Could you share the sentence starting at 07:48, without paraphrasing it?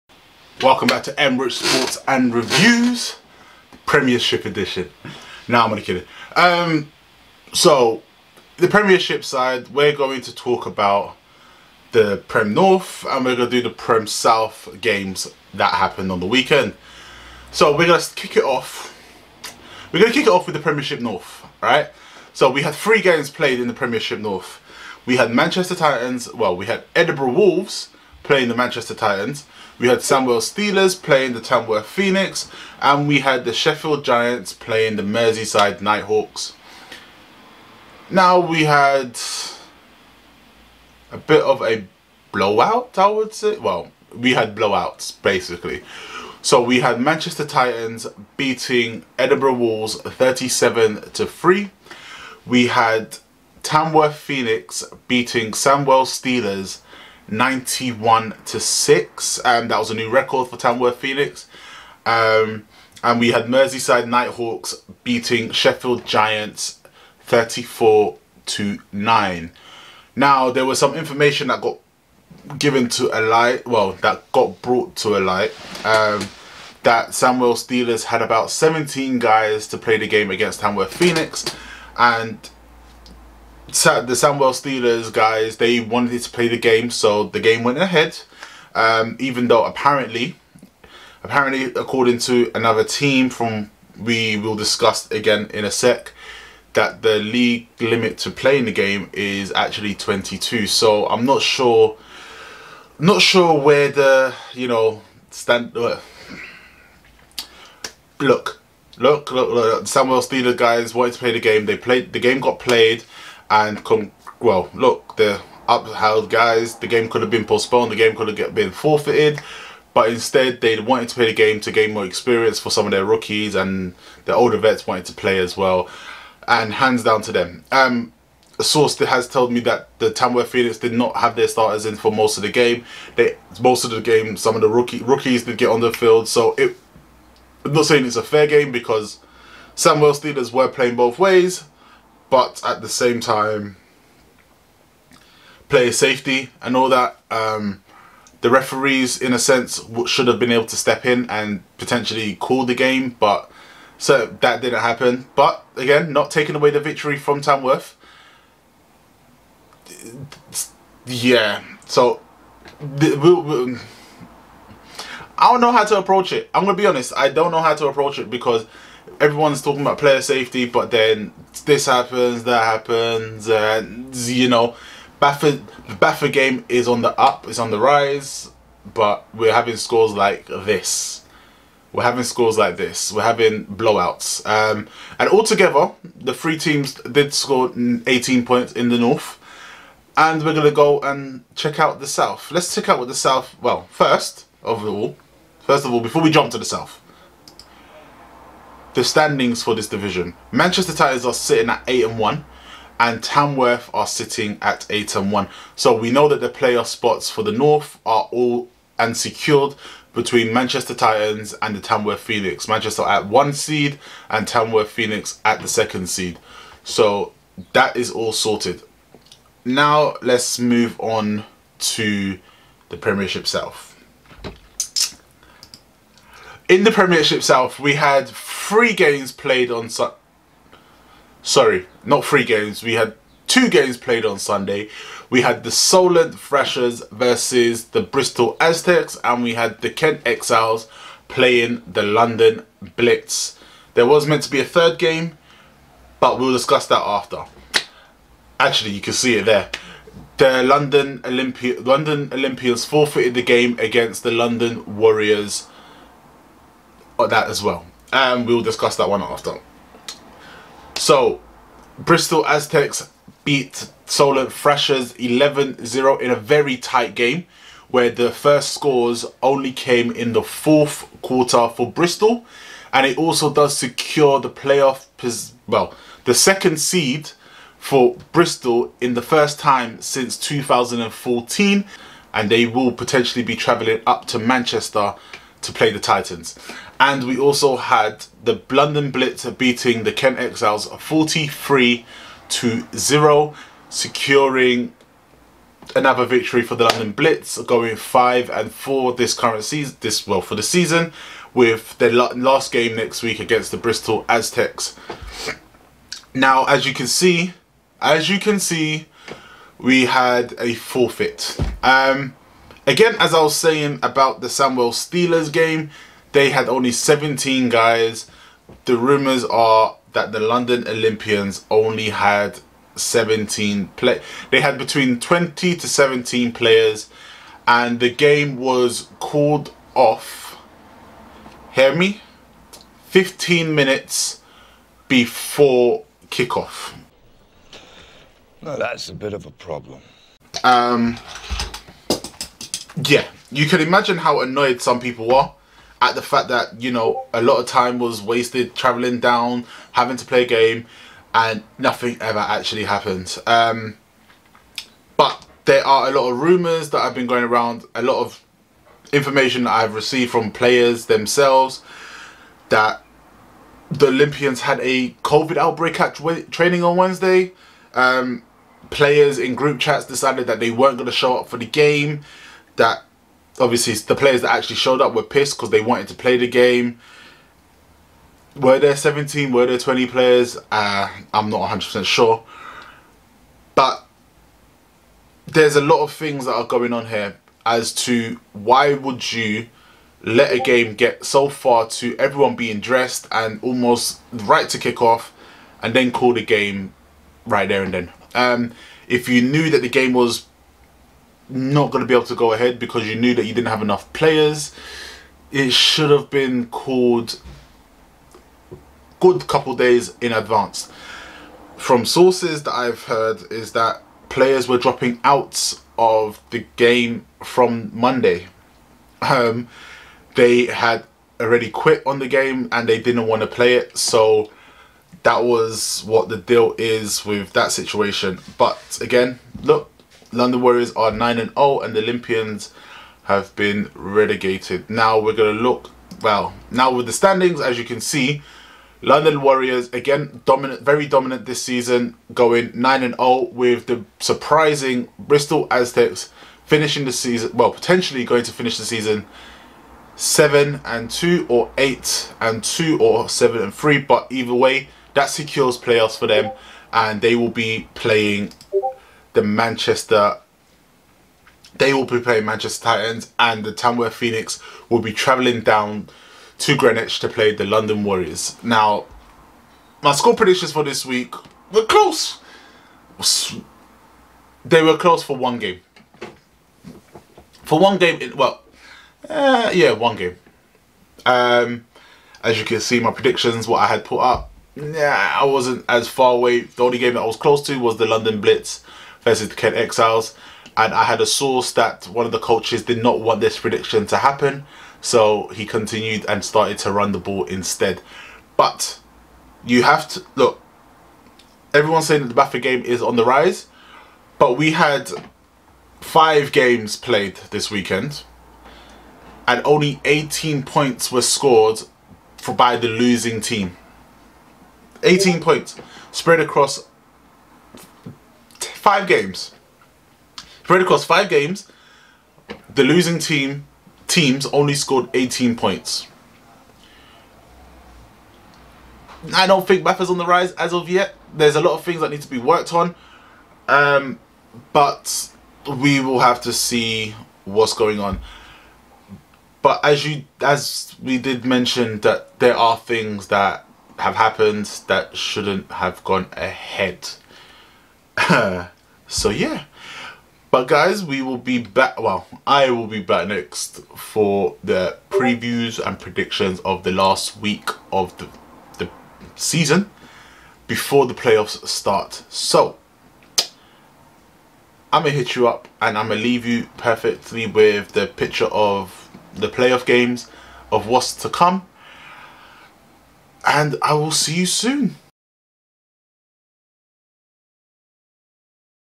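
Now, my score predictions for this week were close.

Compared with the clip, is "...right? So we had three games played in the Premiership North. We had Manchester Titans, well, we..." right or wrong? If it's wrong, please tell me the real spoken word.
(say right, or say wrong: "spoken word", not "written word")
right.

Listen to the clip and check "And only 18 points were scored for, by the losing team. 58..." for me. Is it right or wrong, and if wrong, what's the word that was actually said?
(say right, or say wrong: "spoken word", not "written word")
wrong: "18", not "58".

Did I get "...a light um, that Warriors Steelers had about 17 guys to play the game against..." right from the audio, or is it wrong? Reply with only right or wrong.
wrong.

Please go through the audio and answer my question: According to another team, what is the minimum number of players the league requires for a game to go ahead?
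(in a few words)
22.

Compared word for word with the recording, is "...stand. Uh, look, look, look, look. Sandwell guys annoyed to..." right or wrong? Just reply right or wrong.
wrong.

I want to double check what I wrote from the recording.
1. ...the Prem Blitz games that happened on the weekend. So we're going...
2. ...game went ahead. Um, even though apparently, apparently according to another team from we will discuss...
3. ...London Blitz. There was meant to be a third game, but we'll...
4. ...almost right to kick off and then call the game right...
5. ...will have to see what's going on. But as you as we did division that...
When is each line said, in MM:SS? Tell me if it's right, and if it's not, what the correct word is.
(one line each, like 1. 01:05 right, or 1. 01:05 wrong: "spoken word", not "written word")
1. 00:13 wrong: "South", not "Blitz"
2. 01:27 right
3. 04:02 right
4. 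06:33 right
5. 08:55 wrong: "mention", not "division".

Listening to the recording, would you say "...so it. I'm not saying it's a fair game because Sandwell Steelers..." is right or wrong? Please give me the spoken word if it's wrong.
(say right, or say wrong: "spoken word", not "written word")
right.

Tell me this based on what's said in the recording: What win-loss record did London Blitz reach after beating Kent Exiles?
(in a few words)
5 and 4.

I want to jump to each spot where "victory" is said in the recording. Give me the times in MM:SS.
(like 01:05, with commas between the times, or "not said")
02:36, 04:56.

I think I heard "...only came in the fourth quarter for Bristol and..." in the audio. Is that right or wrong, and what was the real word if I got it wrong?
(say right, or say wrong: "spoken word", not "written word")
right.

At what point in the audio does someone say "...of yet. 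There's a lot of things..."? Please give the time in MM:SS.
08:50.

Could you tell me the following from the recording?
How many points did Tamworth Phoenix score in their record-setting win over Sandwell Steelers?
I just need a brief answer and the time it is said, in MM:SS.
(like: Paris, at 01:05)
91, at 00:57.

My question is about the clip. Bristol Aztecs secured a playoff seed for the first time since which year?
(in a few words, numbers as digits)
2014.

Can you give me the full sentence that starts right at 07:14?
Now we're going to look well.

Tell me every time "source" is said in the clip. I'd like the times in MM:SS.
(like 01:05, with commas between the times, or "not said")
02:08, 06:52, 08:11.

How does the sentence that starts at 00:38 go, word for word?
Now we had a bit of a blowout, I would say.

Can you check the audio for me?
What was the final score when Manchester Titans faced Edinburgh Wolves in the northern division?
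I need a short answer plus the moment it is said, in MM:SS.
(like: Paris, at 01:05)
37 to 3, at 00:50.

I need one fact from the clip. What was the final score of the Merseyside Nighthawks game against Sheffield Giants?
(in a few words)
34 to 9.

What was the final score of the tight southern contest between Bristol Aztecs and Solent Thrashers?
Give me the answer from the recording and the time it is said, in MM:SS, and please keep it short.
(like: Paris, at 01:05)
11-0, at 04:25.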